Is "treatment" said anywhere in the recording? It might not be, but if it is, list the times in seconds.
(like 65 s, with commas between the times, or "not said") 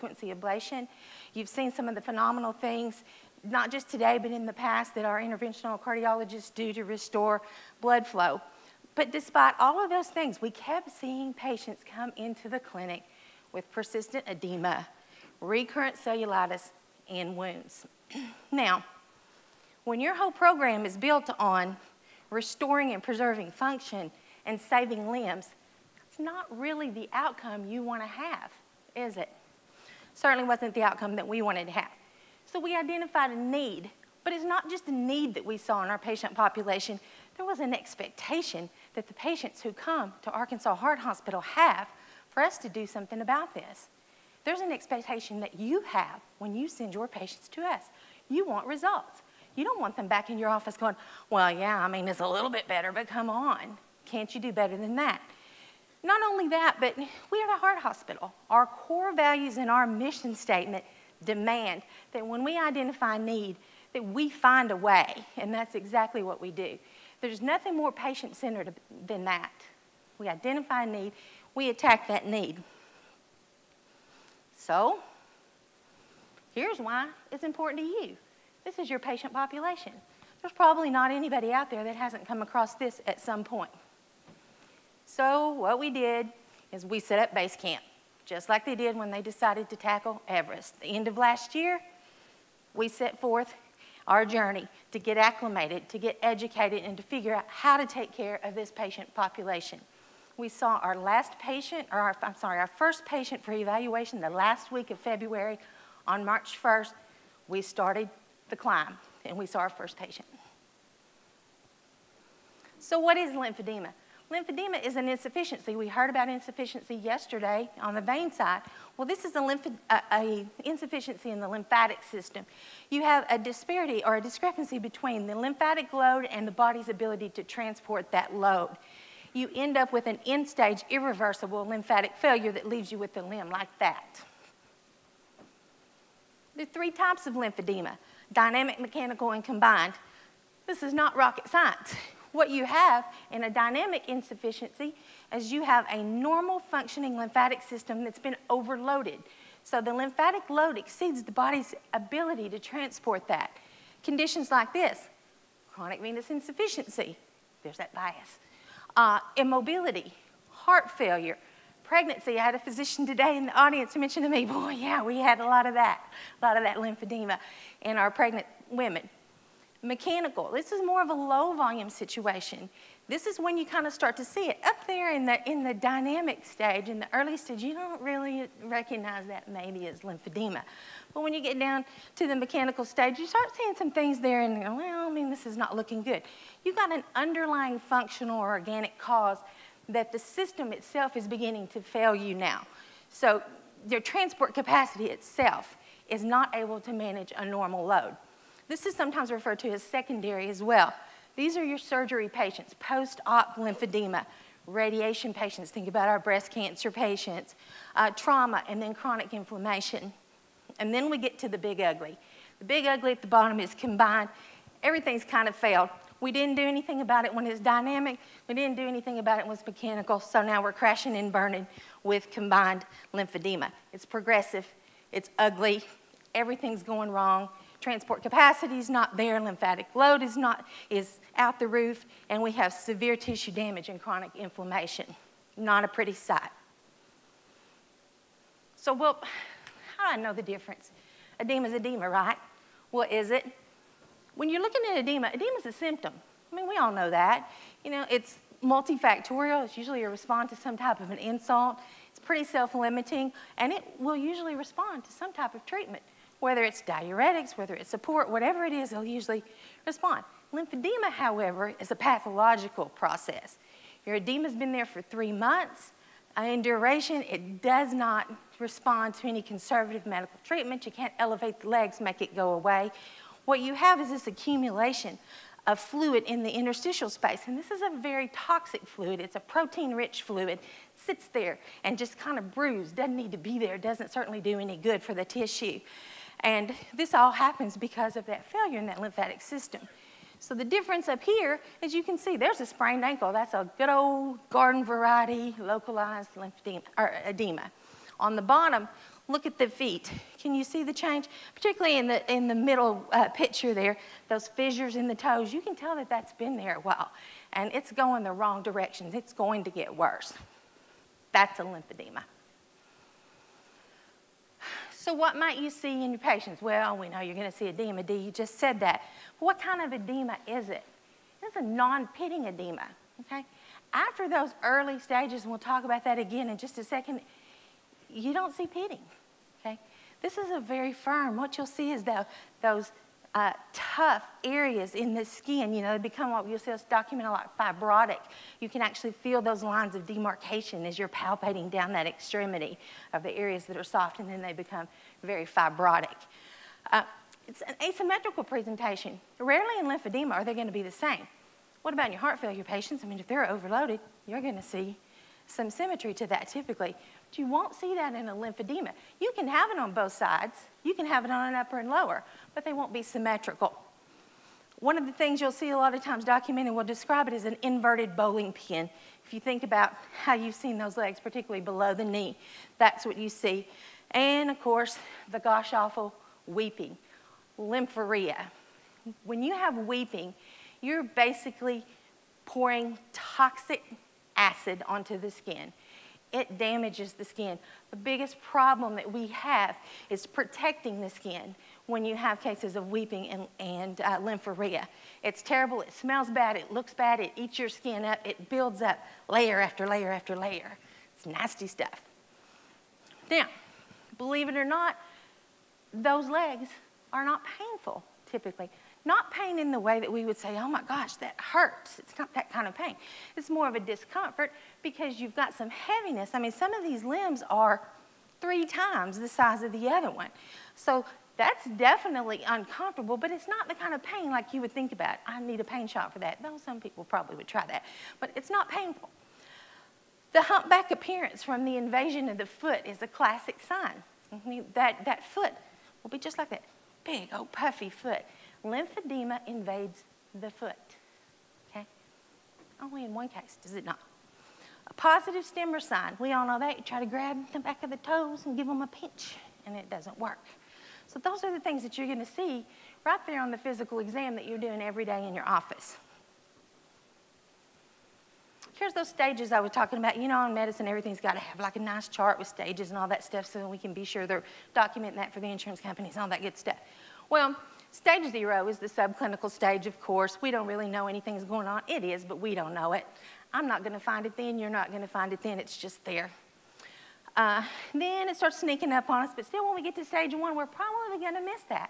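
255 s, 270 s.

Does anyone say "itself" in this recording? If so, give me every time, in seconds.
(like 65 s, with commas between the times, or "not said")
190 s, 195 s.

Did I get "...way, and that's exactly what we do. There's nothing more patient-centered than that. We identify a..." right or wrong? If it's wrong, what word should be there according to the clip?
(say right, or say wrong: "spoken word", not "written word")
right.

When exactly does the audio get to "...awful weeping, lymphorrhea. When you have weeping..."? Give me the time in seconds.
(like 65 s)
375 s.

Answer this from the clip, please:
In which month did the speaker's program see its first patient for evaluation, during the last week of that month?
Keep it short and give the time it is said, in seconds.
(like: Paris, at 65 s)
February, at 104 s.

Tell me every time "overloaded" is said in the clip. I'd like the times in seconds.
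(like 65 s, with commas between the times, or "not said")
148 s, 353 s.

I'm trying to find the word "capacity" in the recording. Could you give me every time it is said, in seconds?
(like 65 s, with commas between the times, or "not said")
194 s, 228 s.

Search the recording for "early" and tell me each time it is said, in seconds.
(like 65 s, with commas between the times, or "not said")
177 s, 324 s.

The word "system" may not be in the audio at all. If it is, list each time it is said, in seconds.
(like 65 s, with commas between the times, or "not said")
122 s, 147 s, 190 s, 289 s.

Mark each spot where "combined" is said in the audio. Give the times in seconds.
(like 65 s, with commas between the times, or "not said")
139 s, 213 s, 222 s.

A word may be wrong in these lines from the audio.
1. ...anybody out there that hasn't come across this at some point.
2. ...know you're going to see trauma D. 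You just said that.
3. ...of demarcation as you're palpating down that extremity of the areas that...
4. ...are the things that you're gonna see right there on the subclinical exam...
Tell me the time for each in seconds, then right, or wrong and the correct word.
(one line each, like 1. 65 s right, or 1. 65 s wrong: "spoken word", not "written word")
1. 81 s right
2. 317 s wrong: "edema", not "trauma"
3. 339 s right
4. 451 s wrong: "physical", not "subclinical".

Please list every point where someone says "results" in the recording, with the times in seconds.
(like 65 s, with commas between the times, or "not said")
48 s.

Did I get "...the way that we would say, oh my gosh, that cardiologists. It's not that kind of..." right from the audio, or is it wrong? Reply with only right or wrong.
wrong.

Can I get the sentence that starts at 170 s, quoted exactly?
This is more of a low volume situation.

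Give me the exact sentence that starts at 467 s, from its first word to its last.
Well, Stage zero is the subclinical stage, of course.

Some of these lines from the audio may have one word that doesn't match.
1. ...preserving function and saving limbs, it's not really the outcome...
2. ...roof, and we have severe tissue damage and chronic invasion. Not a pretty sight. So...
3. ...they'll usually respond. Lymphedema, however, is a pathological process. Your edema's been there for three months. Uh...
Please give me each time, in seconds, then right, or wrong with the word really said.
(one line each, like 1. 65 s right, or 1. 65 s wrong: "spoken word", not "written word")
1. 23 s right
2. 231 s wrong: "inflammation", not "invasion"
3. 258 s right.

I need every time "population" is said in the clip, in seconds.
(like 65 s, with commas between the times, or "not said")
36 s, 79 s, 99 s.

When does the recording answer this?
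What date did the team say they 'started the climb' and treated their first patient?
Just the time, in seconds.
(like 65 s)
106 s.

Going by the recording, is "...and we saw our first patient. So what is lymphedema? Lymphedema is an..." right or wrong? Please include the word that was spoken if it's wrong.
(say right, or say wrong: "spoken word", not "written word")
right.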